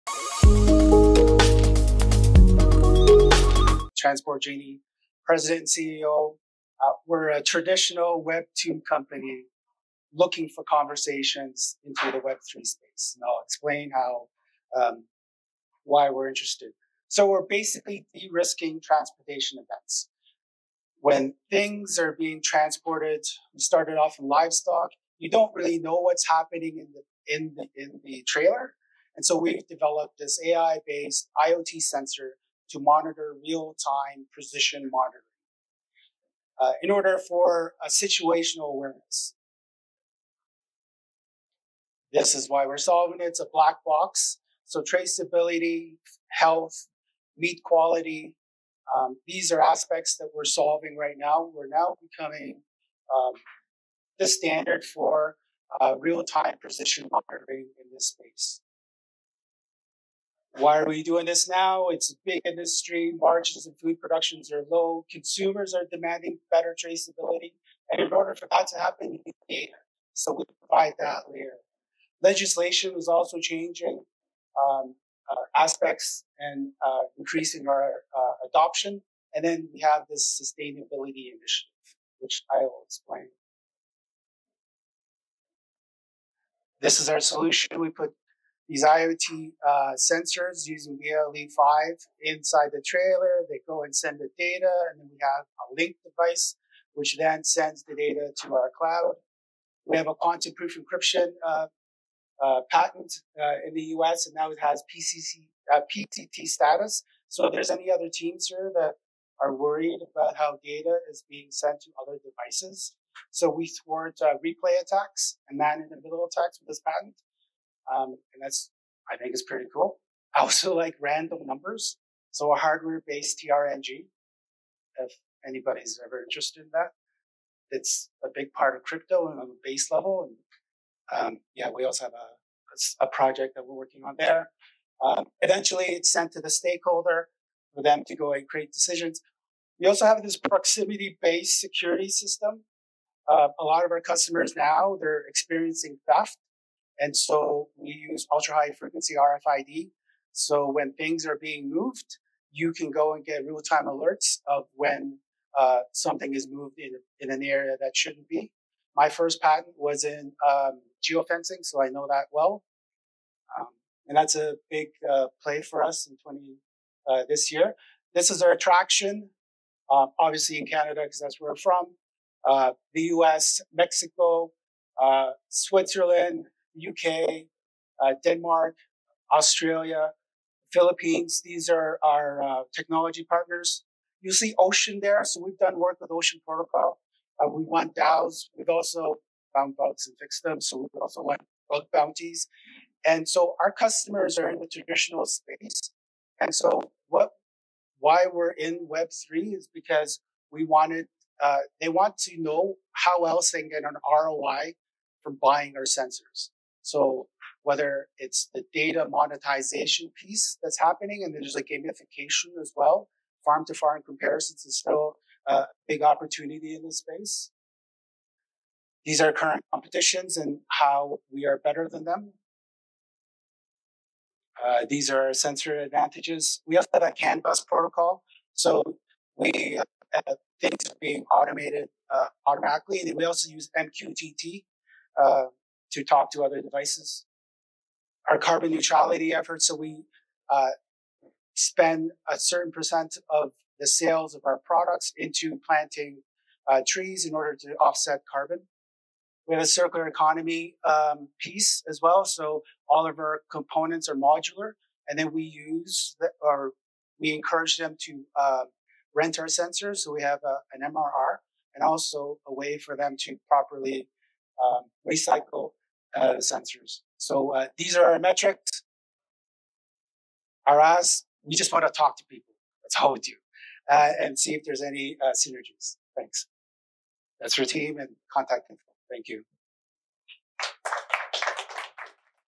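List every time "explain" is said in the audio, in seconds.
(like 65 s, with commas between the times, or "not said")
13 s, 82 s.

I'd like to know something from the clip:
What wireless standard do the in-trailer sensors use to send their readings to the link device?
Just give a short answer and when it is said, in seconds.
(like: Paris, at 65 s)
BLE5, at 90 s.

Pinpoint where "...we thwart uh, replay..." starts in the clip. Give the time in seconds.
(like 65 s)
113 s.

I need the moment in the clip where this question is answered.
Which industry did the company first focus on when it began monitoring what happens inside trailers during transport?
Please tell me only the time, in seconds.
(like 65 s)
24 s.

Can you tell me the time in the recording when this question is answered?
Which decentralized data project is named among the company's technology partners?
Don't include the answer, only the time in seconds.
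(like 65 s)
186 s.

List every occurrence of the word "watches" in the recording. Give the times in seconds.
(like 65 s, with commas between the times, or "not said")
not said.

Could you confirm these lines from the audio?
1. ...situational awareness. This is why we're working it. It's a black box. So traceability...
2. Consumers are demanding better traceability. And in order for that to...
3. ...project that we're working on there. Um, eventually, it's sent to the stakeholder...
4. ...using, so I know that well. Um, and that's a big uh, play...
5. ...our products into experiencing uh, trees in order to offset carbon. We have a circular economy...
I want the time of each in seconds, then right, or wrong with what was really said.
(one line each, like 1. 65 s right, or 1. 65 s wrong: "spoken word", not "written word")
1. 37 s wrong: "solving", not "working"
2. 65 s right
3. 133 s right
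4. 161 s wrong: "geofencing", not "using"
5. 244 s wrong: "planting", not "experiencing".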